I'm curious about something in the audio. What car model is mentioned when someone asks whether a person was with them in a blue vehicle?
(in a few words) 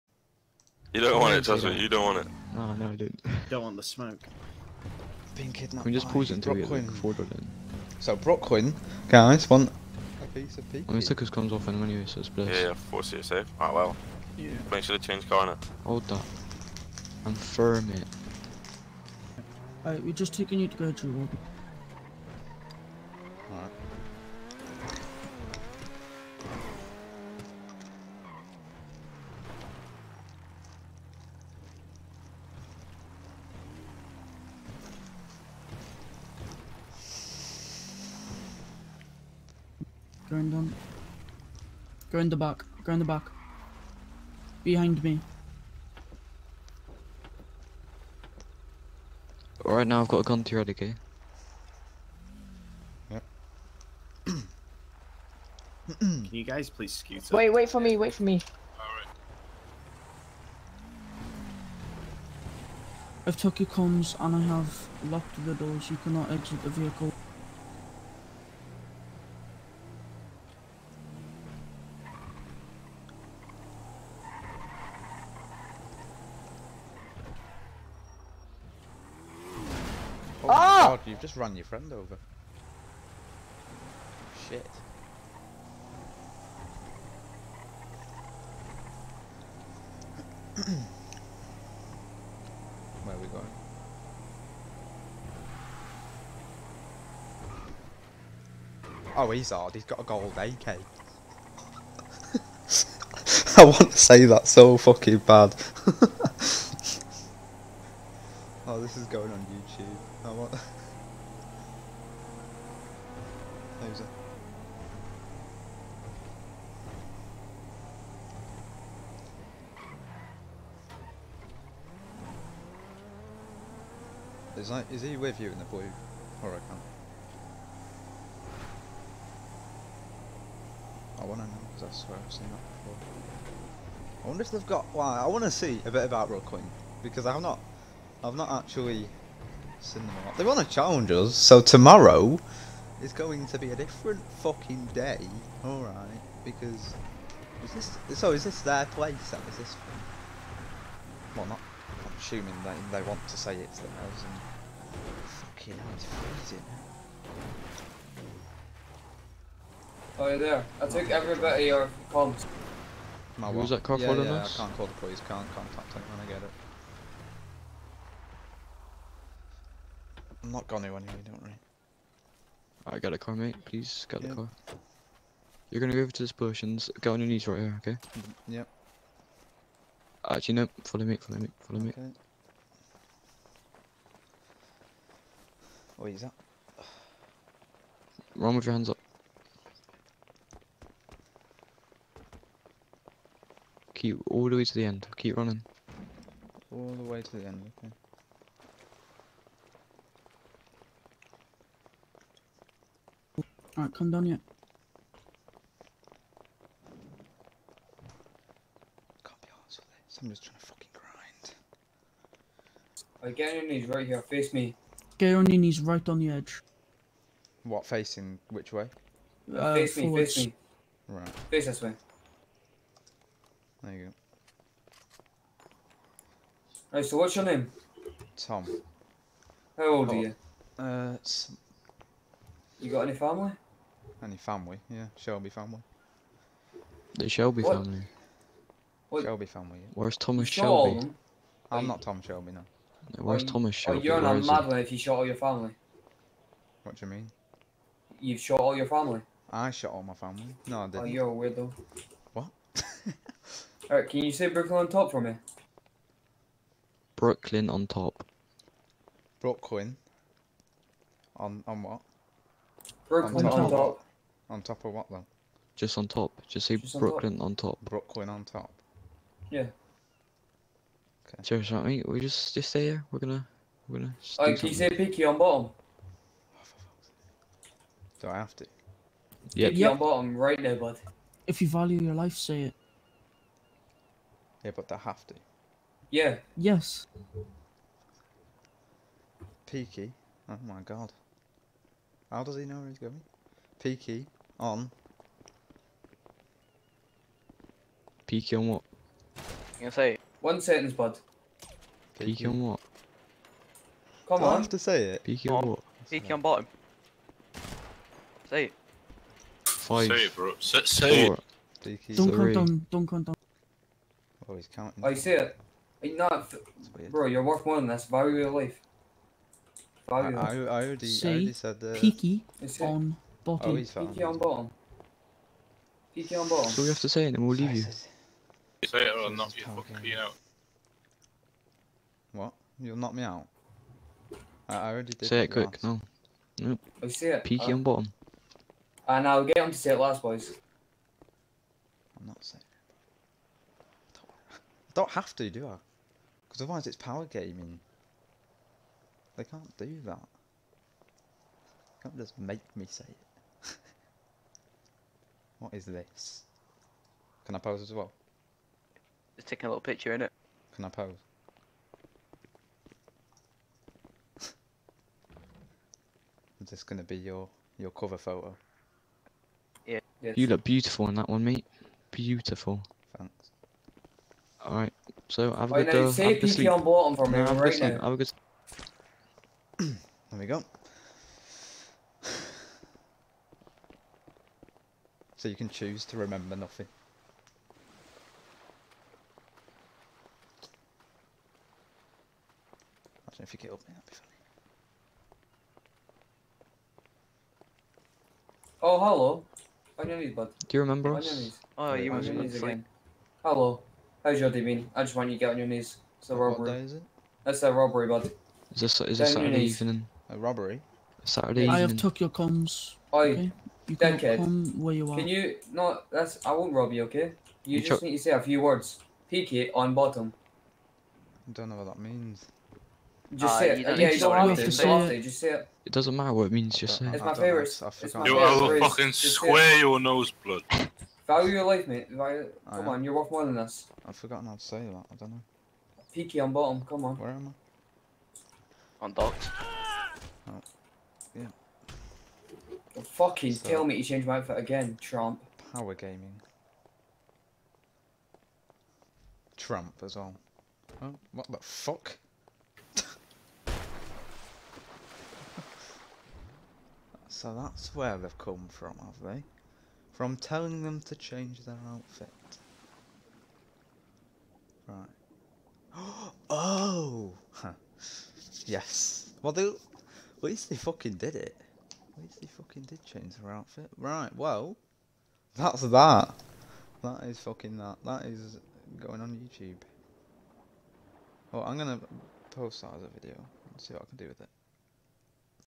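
Huracan.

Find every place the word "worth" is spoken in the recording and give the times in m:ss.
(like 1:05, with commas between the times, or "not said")
5:17, 7:13.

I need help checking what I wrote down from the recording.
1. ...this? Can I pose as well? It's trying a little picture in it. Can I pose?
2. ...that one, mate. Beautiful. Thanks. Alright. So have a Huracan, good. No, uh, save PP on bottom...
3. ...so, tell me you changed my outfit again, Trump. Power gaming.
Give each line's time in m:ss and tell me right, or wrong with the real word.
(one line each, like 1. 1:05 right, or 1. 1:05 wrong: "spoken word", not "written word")
1. 5:55 wrong: "taking", not "trying"
2. 6:11 wrong: "Wait", not "Huracan"
3. 7:23 right.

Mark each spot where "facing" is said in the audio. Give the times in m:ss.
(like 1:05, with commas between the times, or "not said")
3:37.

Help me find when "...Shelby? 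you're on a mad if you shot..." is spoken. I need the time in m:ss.
4:03.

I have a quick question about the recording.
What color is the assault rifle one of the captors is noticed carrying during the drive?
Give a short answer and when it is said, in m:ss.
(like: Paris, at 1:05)
Gold, at 1:40.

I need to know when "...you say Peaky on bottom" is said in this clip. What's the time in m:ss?
4:34.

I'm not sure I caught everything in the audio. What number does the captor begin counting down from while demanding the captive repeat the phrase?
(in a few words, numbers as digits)
5.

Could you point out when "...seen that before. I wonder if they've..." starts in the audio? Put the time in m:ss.
2:12.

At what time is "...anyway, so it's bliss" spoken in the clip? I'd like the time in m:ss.
0:11.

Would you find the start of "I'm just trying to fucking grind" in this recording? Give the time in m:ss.
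3:30.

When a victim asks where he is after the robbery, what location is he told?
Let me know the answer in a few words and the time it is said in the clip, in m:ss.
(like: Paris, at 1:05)
Docks, at 7:19.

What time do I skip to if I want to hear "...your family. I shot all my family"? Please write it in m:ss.
4:08.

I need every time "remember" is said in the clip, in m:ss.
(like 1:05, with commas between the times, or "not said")
6:26, 6:40.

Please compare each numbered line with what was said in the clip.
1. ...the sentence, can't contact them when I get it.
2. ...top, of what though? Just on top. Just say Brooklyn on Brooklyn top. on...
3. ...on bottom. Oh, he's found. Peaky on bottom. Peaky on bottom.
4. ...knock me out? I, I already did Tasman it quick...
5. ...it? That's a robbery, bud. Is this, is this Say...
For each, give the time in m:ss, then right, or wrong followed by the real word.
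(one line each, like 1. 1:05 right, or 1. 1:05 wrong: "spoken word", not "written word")
1. 2:44 wrong: "police", not "sentence"
2. 4:24 wrong: "Just", not "Brooklyn"
3. 5:22 right
4. 5:32 wrong: "Say", not "Tasman"
5. 6:46 wrong: "Saturday", not "Say".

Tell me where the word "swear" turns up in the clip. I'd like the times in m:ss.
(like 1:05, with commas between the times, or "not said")
2:12, 7:09.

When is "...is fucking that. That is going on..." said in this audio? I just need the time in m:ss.
7:57.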